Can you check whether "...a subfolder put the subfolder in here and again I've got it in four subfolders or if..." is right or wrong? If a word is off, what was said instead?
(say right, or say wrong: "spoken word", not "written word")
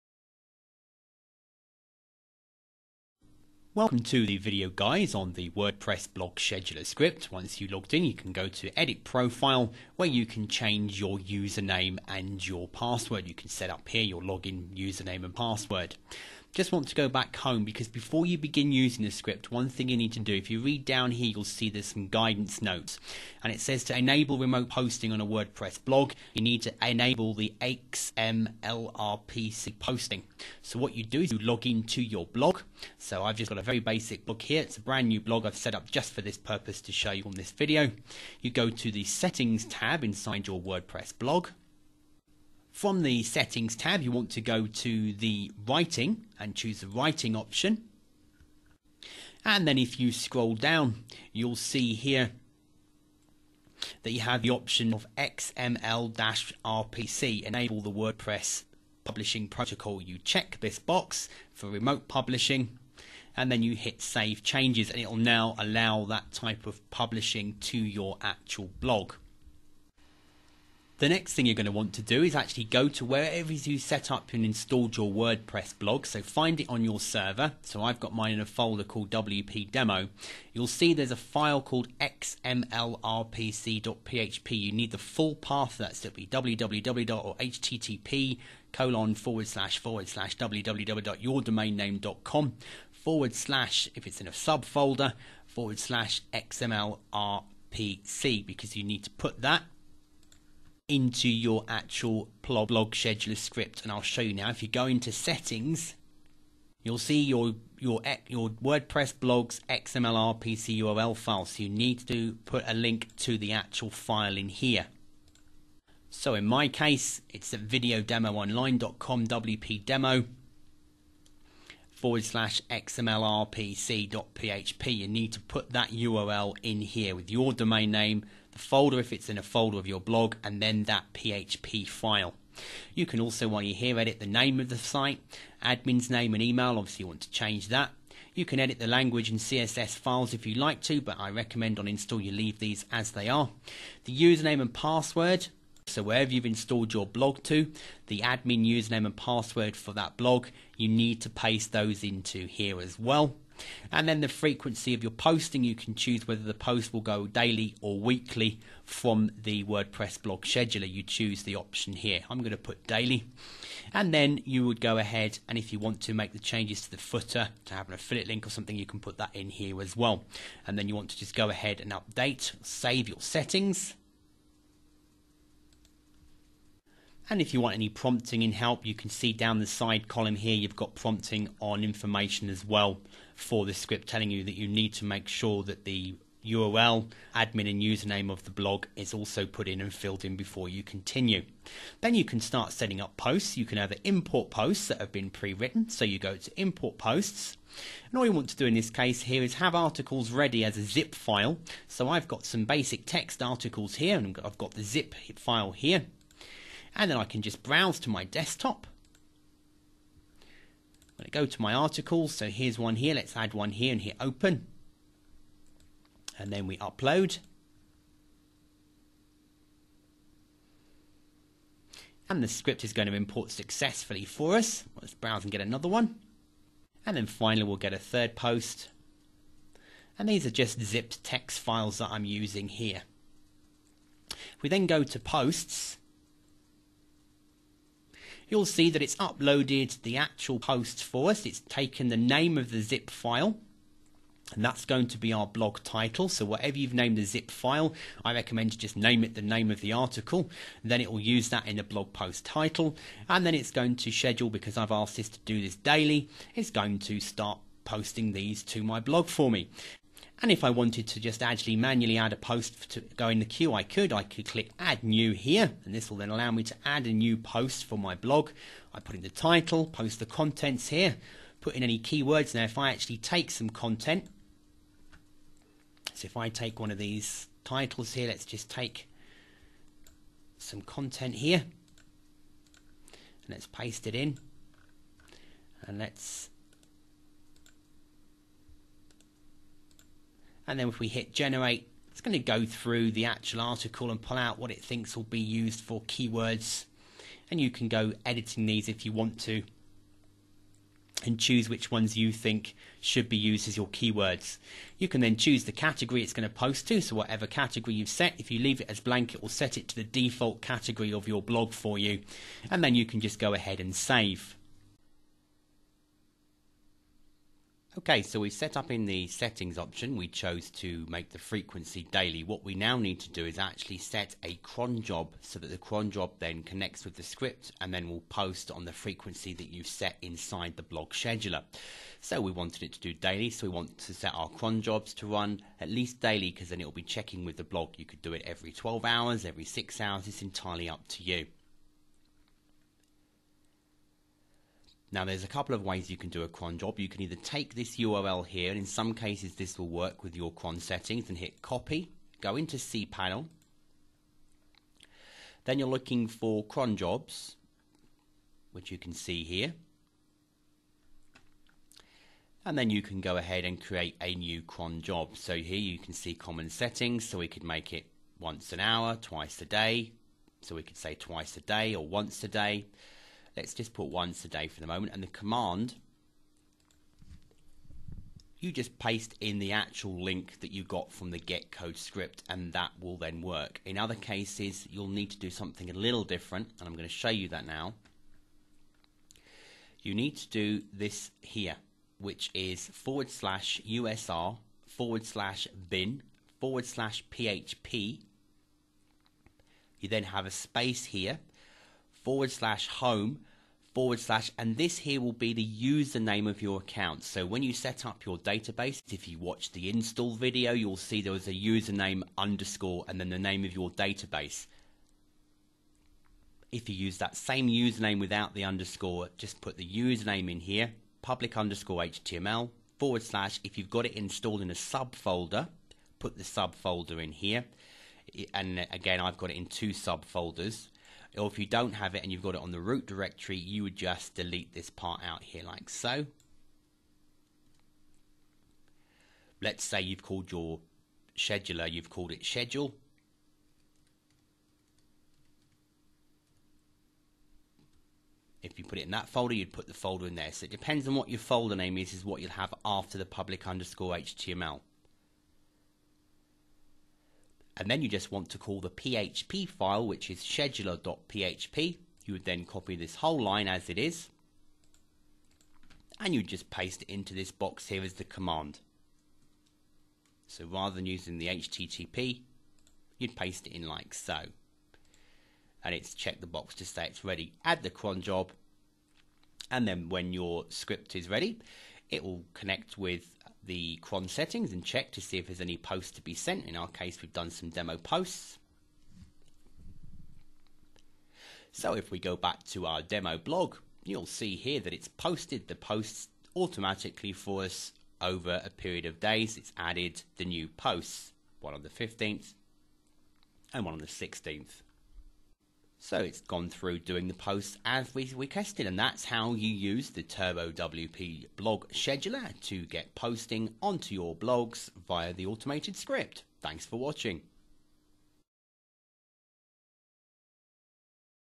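wrong: "two", not "four".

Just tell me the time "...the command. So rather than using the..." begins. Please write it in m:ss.
7:48.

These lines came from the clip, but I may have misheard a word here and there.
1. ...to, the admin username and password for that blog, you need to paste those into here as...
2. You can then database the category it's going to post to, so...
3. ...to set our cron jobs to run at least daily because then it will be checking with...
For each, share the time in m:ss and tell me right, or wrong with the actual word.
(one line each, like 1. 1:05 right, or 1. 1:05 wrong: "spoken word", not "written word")
1. 2:27 right
2. 5:04 wrong: "choose", not "database"
3. 5:33 right.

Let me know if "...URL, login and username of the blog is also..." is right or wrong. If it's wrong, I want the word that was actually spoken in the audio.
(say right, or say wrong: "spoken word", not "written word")
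wrong: "admin", not "login".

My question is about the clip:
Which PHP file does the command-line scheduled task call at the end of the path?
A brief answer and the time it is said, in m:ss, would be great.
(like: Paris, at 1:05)
scheduler.php, at 7:40.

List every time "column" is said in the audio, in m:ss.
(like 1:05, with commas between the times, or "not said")
3:00.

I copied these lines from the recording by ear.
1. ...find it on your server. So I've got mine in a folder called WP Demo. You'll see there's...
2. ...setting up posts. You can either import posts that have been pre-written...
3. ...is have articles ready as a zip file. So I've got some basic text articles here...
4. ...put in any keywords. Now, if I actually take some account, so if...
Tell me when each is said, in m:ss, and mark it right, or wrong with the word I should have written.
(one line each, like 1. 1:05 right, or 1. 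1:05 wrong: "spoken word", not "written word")
1. 1:16 right
2. 3:12 right
3. 3:19 right
4. 4:31 wrong: "content", not "account".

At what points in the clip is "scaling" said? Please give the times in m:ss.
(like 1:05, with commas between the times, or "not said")
not said.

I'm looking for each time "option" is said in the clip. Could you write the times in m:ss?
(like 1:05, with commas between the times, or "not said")
0:47, 0:54, 2:41, 5:19.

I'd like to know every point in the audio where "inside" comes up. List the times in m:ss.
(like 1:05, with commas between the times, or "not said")
0:40, 5:30.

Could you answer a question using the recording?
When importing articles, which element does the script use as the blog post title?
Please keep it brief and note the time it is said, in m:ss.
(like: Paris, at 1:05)
name of the zip file, at 4:02.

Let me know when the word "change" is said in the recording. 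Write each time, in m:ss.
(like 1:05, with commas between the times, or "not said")
0:10, 1:04, 2:17, 2:46.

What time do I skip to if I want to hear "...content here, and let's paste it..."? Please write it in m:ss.
4:40.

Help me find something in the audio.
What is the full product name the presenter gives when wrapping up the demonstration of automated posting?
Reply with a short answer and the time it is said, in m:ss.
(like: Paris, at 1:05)
Turbo WP blog scheduler, at 8:30.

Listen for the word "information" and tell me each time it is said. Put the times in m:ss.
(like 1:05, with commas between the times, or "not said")
3:01.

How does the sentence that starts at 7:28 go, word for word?
If you put it in that folder, you'd put the folder in there.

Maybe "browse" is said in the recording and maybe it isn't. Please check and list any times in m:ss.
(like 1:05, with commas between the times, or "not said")
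3:27, 3:45.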